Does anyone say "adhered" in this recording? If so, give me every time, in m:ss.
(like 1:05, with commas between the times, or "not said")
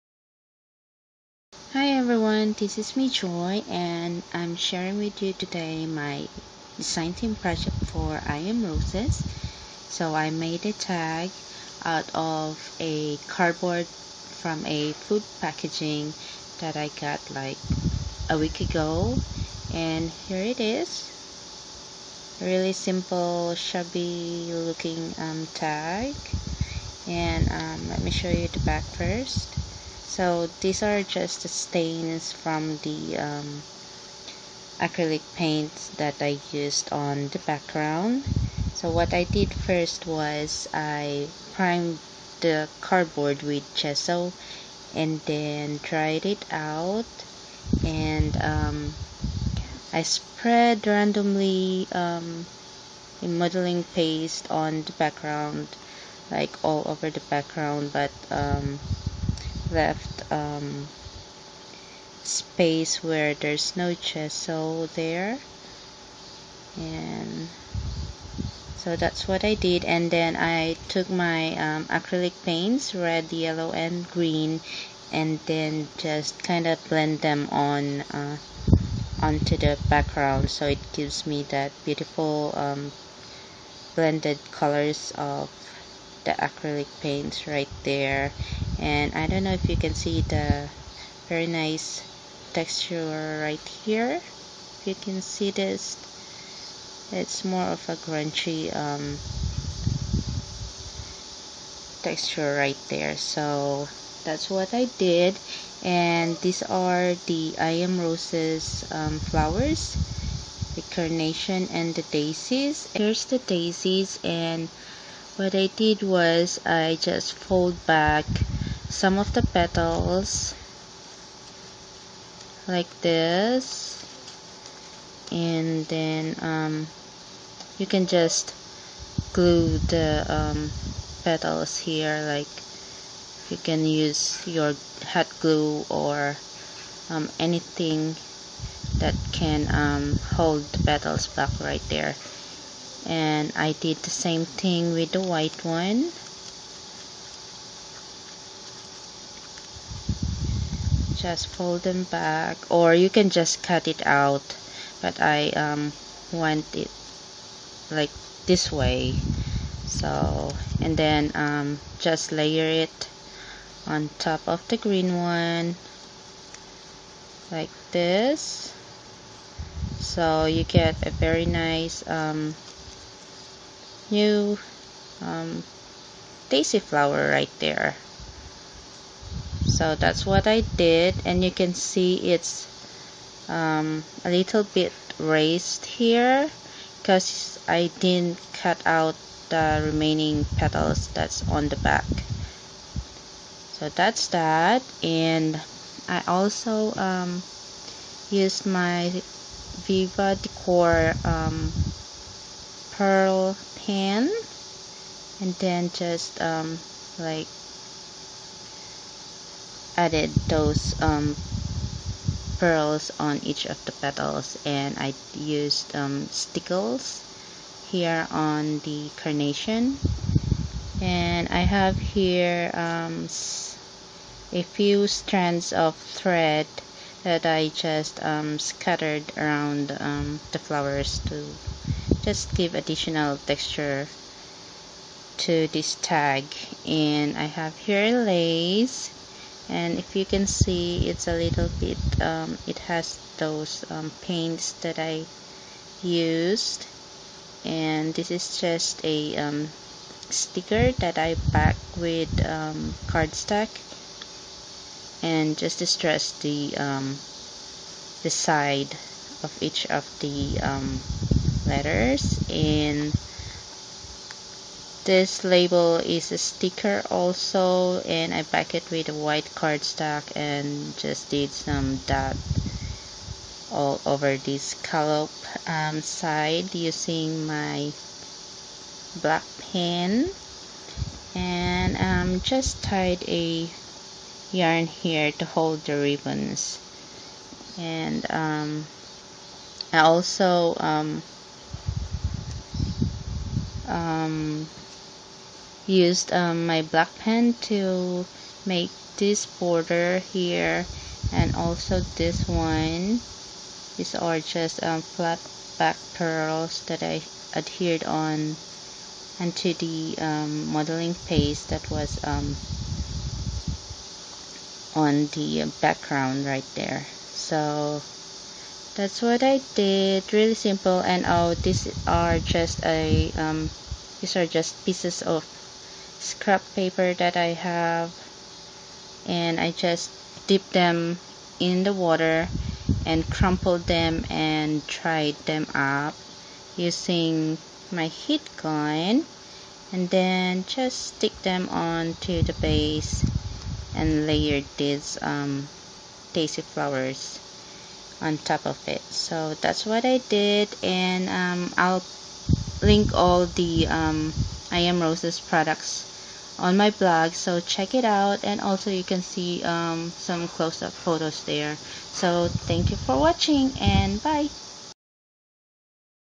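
5:07.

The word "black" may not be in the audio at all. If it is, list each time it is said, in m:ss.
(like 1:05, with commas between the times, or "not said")
4:39, 4:56.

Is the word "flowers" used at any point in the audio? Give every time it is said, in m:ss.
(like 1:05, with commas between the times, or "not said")
1:49, 2:56, 3:50, 5:46.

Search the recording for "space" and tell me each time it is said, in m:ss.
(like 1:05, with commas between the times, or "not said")
1:02.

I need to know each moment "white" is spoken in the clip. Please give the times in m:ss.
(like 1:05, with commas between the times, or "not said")
2:25, 4:29.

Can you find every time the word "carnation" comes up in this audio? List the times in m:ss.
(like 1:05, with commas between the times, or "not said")
1:50, 3:39.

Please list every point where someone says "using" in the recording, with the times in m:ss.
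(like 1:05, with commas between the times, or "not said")
4:36, 5:36.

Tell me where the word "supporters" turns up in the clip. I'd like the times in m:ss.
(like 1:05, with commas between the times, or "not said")
not said.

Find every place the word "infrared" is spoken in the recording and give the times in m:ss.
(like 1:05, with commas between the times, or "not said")
not said.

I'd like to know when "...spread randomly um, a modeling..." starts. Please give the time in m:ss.
0:50.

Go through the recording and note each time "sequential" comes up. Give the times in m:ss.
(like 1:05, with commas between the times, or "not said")
not said.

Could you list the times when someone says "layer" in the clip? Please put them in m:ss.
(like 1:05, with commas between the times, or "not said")
2:42, 5:44.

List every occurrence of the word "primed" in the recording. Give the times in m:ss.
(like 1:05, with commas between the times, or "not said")
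0:41.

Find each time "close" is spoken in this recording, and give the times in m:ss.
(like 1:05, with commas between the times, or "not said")
6:00.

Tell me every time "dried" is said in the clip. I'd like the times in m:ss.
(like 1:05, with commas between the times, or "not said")
0:45, 5:34.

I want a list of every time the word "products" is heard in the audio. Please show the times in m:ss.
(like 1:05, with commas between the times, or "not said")
5:55.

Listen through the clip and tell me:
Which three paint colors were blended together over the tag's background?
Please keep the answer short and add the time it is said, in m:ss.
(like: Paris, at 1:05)
Red, yellow and green, at 1:12.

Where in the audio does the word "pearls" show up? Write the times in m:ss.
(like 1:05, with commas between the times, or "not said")
3:22, 3:32, 5:06.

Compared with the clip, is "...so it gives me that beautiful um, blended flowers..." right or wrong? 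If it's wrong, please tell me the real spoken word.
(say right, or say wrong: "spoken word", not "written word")
wrong: "colors", not "flowers".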